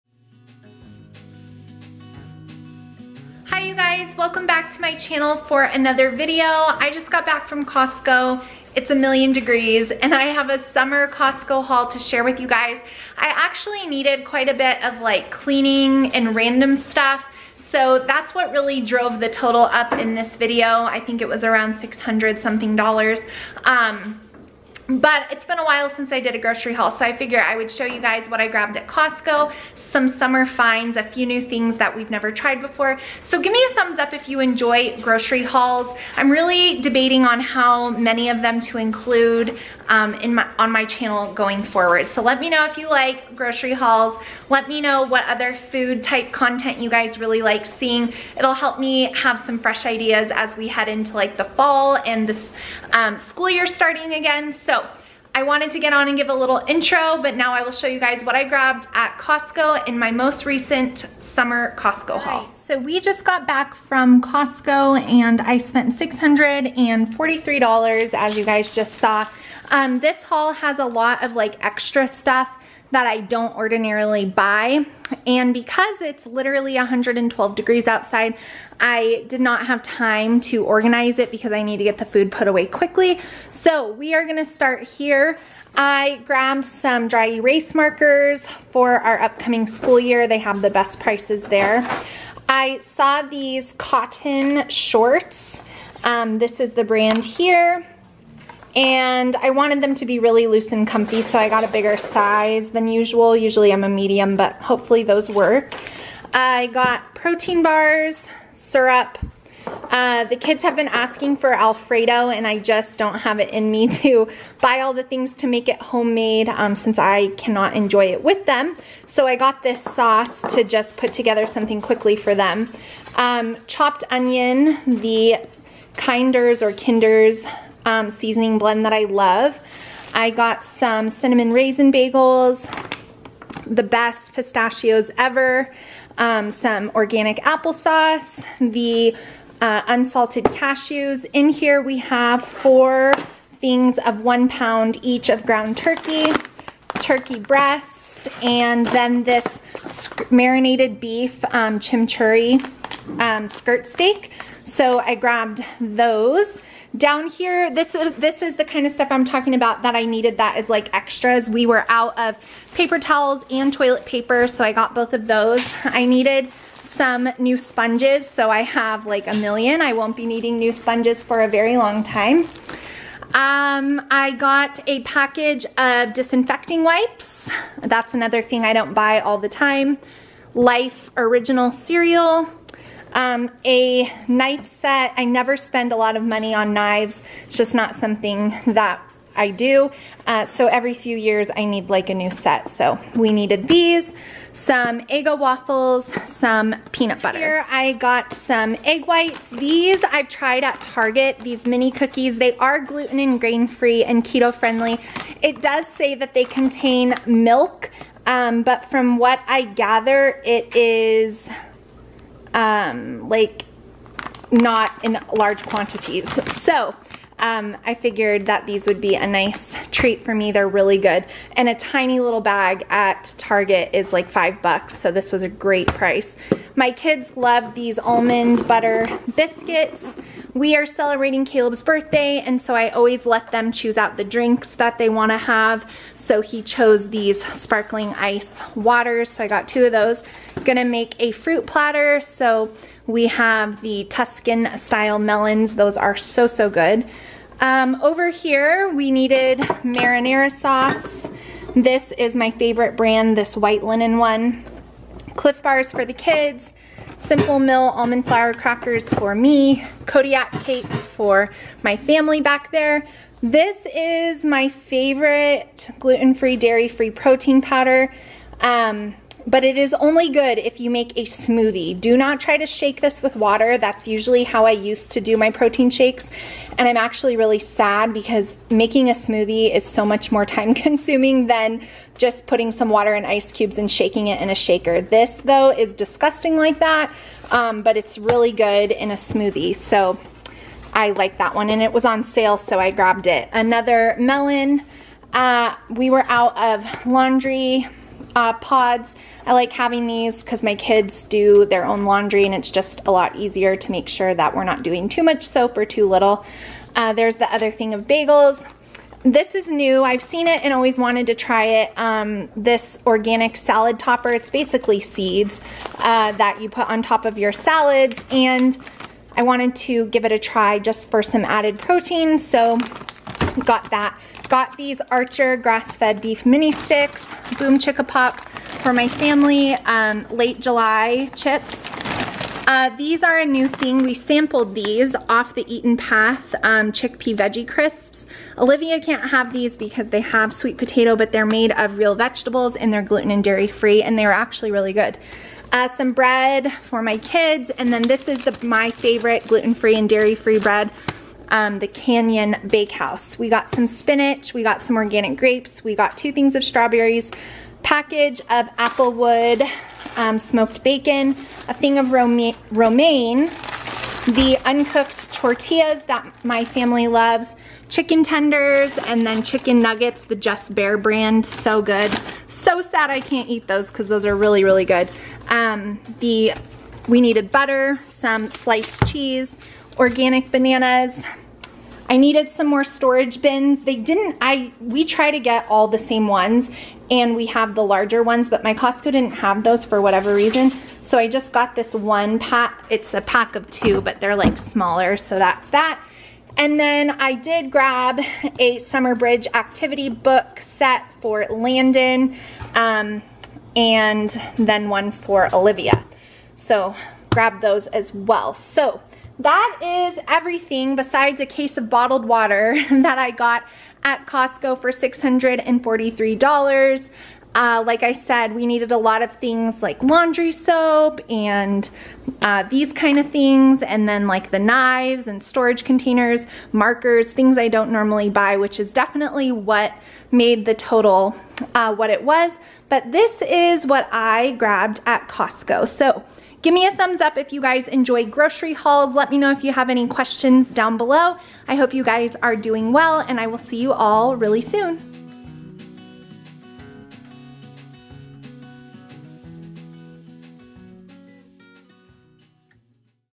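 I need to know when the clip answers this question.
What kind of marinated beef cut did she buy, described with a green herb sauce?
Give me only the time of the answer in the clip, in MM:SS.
02:33.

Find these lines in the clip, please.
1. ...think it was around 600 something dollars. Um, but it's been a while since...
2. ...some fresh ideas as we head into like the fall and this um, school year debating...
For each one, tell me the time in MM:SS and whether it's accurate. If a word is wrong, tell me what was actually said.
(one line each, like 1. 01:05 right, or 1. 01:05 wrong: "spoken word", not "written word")
1. 00:20 right
2. 00:49 wrong: "starting", not "debating".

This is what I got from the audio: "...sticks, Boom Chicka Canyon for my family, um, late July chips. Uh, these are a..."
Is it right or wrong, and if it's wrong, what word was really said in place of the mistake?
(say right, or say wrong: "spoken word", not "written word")
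wrong: "Pop", not "Canyon".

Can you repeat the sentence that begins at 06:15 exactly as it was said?
Um, the We needed butter, some sliced cheese, organic bananas, I needed some more storage bins.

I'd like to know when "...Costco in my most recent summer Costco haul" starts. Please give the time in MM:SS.
00:59.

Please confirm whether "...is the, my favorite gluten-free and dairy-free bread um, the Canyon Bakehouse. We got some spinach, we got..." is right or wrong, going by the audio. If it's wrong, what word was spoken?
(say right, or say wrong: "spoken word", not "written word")
right.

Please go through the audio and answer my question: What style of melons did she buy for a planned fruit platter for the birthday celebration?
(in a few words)
Tuscan style.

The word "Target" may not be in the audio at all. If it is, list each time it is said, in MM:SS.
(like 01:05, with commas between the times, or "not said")
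03:20, 03:43.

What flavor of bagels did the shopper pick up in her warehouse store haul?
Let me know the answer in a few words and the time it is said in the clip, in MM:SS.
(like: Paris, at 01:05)
cinnamon raisin, at 02:11.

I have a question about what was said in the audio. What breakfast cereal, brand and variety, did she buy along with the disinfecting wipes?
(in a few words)
Life Original.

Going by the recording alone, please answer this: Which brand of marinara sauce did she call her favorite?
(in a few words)
White Linen.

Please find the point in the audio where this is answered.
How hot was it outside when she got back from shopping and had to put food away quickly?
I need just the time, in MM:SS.
01:16.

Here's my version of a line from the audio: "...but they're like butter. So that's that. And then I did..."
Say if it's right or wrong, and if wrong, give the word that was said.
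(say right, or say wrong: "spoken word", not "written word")
wrong: "smaller", not "butter".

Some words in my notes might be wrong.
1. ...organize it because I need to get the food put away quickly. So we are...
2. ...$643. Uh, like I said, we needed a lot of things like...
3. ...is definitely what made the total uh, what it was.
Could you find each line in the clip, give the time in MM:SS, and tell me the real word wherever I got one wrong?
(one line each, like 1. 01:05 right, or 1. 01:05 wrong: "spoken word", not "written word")
1. 01:20 right
2. 06:54 right
3. 07:08 right.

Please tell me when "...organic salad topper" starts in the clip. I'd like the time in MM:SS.
05:13.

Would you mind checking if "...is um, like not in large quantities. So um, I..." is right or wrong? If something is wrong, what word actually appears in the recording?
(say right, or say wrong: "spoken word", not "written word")
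right.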